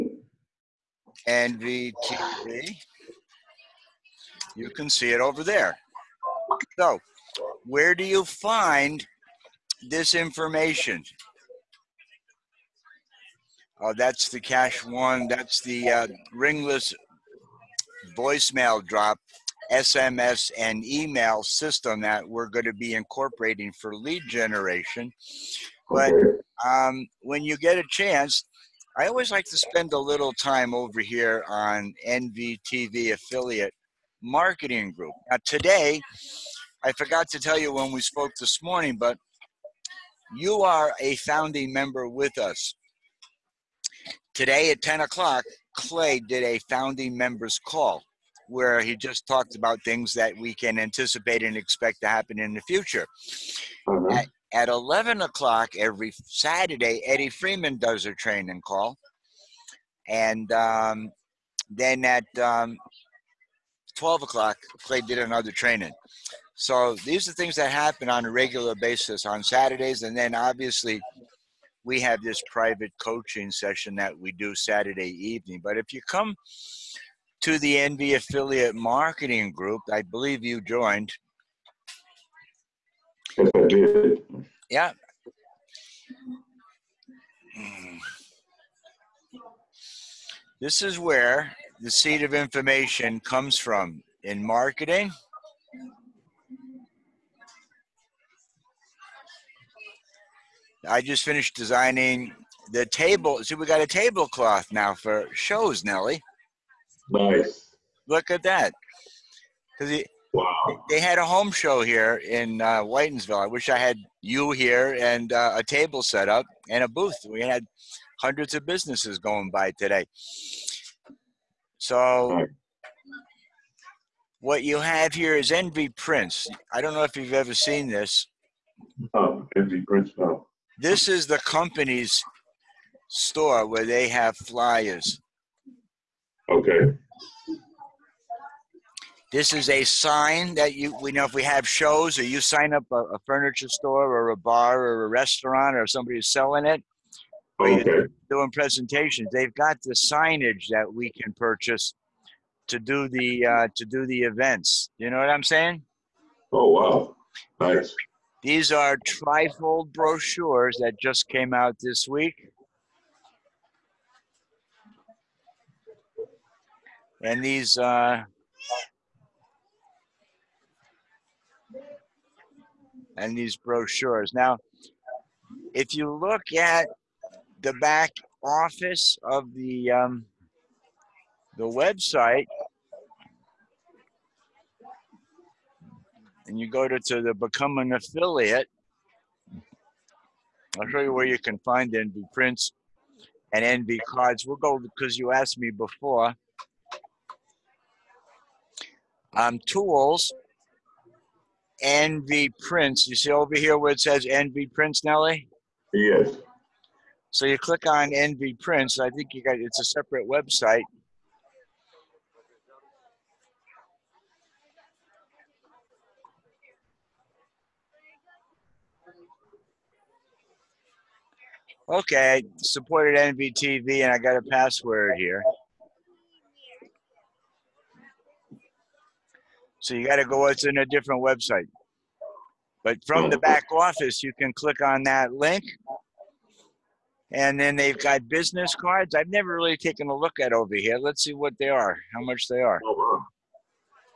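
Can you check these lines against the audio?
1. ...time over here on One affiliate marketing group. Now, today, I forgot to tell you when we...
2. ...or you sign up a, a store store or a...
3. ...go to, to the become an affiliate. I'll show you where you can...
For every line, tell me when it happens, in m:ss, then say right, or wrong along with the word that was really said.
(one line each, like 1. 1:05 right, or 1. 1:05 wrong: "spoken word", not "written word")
1. 0:30 wrong: "NVTV", not "One"
2. 2:22 wrong: "furniture", not "store"
3. 3:06 right.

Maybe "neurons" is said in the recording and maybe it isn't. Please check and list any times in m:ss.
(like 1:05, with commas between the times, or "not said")
not said.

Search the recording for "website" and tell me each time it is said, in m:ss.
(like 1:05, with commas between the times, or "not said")
3:01, 3:30, 3:51.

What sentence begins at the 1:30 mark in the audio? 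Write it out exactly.
This is where the seed of information comes from in marketing I just finished designing the table.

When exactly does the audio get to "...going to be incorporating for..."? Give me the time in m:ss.
0:22.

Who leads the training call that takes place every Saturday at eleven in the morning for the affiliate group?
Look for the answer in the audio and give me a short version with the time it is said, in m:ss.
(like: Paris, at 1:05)
Eddie Freeman, at 0:57.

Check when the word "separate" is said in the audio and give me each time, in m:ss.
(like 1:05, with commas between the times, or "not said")
3:29.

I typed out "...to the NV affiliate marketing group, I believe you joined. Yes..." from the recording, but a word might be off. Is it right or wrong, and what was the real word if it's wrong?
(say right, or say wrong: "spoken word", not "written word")
right.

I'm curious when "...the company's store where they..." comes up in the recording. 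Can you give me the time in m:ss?
2:11.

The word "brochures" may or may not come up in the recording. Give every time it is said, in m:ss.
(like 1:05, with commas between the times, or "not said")
2:39, 2:53.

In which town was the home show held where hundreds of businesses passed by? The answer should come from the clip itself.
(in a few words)
Whitinsville.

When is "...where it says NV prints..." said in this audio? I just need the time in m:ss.
3:23.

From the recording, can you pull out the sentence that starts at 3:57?
And then they've got business cards.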